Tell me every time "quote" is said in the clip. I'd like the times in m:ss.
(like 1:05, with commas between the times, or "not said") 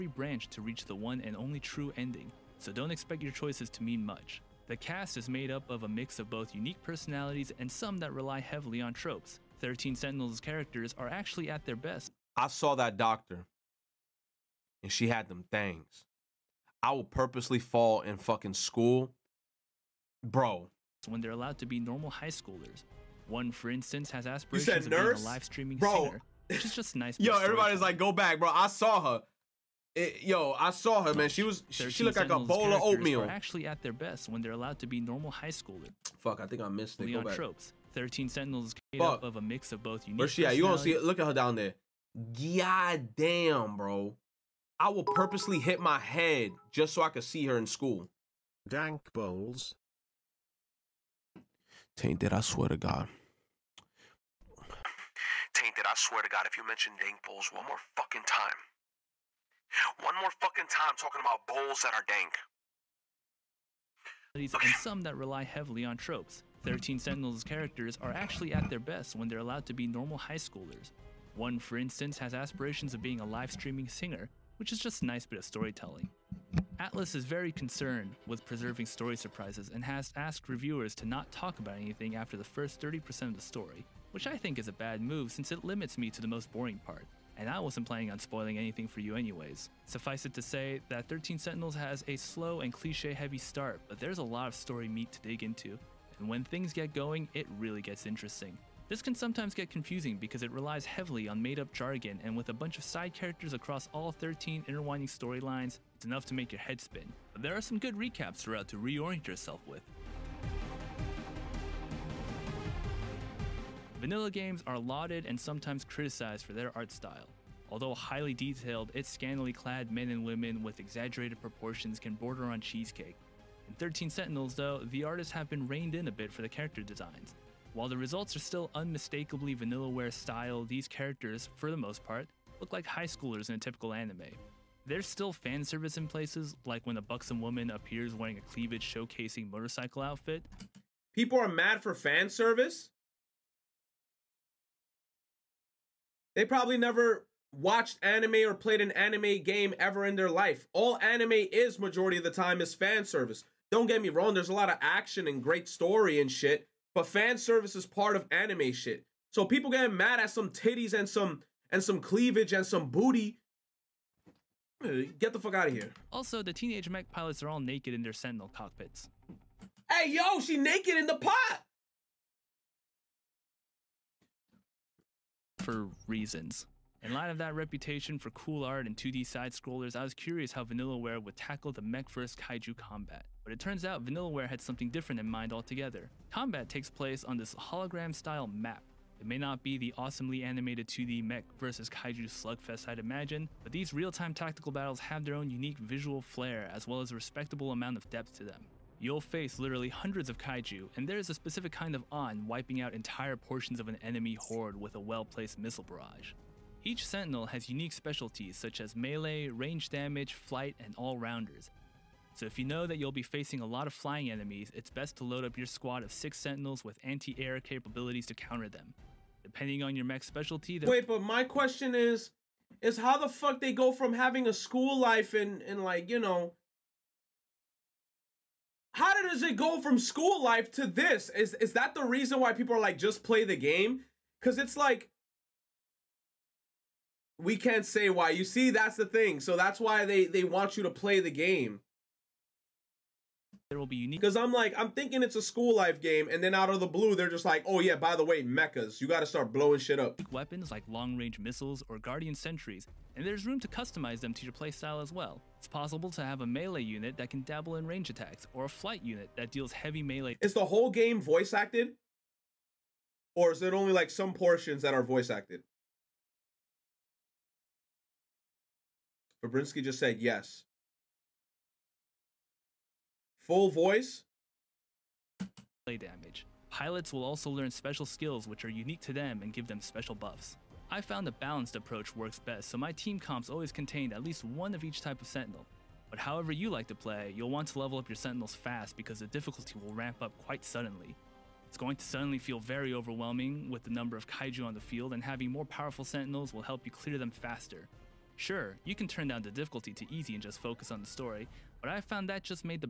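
not said.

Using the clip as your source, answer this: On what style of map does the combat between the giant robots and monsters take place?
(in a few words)
hologram style map.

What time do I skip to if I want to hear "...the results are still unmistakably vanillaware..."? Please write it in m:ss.
2:07.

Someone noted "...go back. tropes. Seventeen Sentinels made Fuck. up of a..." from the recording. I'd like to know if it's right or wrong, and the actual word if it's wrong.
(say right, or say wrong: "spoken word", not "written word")
wrong: "Thirteen", not "Seventeen".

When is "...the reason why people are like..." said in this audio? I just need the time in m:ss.
3:51.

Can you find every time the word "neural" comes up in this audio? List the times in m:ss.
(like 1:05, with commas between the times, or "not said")
not said.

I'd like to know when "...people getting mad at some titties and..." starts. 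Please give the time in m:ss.
2:39.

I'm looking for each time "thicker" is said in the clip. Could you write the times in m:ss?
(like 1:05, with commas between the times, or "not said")
not said.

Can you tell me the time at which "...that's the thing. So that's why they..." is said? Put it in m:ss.
3:58.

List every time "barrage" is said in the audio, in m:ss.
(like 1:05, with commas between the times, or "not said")
3:25.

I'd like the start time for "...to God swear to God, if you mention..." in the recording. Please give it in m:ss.
0:52.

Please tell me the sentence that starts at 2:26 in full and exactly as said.
They probably never watched anime or played an anime game ever in their life.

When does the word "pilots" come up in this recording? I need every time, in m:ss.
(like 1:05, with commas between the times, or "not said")
2:47, 4:36.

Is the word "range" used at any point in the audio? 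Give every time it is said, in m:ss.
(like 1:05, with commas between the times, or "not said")
3:29, 4:10, 4:17.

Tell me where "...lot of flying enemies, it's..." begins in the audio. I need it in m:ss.
3:33.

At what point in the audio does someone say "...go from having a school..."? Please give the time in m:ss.
3:43.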